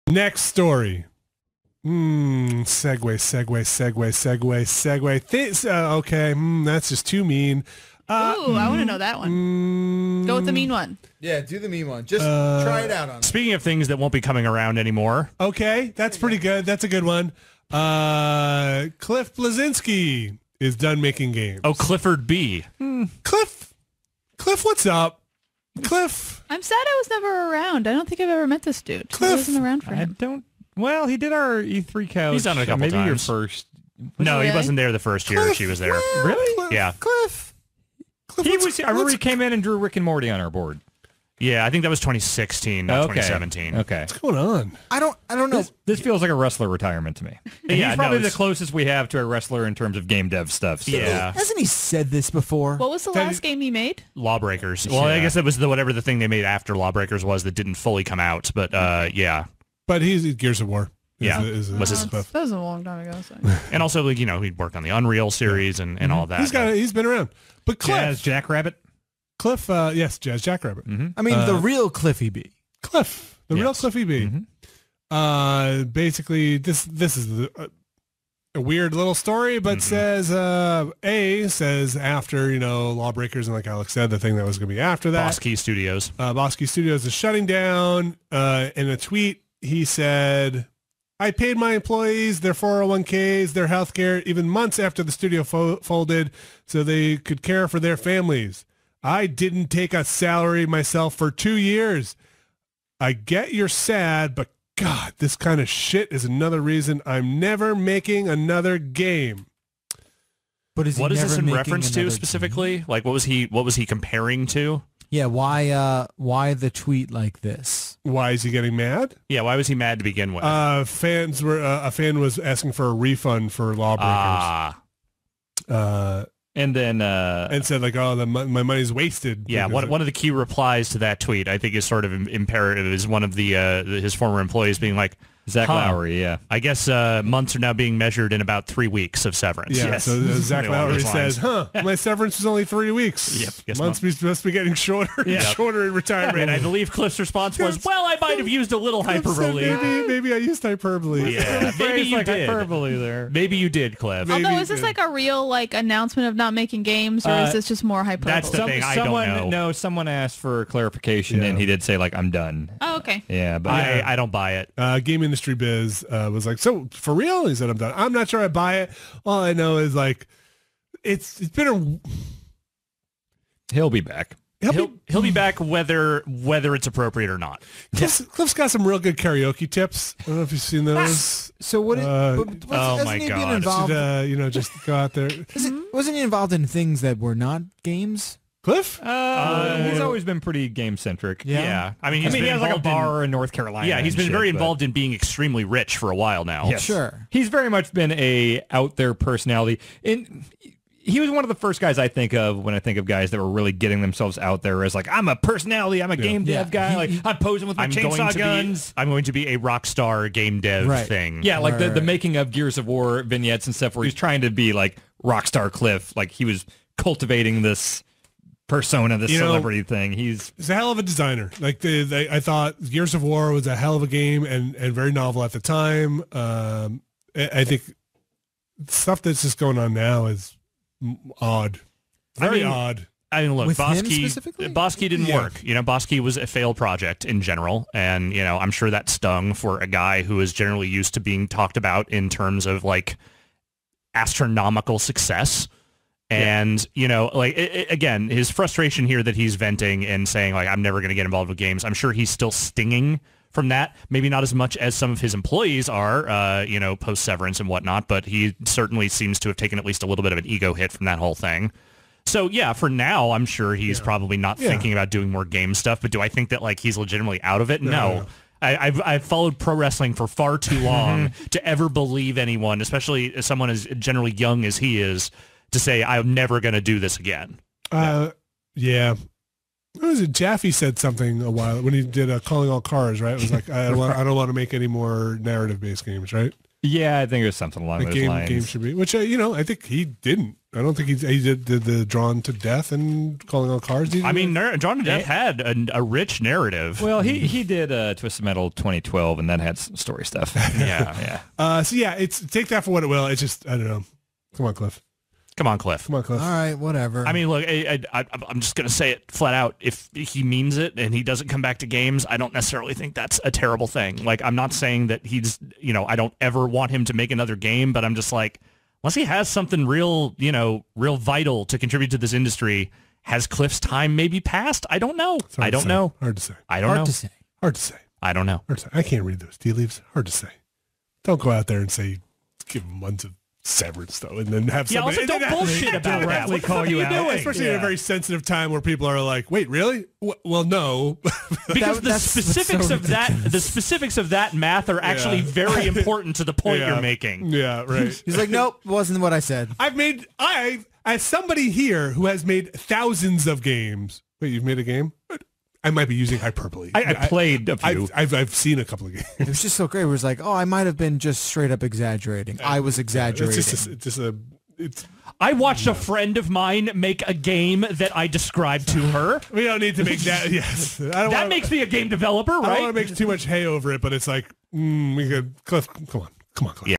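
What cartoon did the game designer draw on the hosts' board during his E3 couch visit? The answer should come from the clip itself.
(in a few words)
Rick and Morty.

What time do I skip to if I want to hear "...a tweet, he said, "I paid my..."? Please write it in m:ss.
1:28.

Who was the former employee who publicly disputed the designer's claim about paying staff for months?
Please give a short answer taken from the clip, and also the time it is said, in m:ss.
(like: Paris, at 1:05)
Zach Lowry, at 2:20.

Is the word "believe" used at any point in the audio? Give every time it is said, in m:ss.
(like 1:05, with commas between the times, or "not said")
2:26, 4:31.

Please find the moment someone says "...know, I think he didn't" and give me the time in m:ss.
4:49.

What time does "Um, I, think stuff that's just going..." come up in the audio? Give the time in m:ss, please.
3:46.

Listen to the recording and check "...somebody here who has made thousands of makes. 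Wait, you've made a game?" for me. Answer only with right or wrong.
wrong.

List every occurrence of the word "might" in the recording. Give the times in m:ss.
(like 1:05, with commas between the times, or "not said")
2:28, 5:55, 6:00.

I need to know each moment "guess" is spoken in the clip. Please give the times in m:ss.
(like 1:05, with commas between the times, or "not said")
0:55, 2:16.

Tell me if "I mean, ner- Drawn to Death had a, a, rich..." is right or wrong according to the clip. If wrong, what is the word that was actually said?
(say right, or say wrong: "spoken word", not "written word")
right.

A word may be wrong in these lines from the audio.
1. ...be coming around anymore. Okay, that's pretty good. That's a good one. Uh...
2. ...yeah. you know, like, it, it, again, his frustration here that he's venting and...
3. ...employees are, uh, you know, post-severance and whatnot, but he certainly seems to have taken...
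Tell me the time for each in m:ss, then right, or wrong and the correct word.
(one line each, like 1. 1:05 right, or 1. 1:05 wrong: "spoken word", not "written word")
1. 0:14 right
2. 4:06 right
3. 4:15 right.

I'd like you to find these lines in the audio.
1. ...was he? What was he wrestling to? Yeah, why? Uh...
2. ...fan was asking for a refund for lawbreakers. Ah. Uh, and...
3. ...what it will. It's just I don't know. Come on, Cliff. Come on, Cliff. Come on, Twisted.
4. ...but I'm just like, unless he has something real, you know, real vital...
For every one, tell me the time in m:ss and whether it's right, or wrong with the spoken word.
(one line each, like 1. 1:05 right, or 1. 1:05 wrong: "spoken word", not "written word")
1. 1:53 wrong: "comparing", not "wrestling"
2. 2:01 right
3. 5:02 wrong: "Cliff", not "Twisted"
4. 5:17 right.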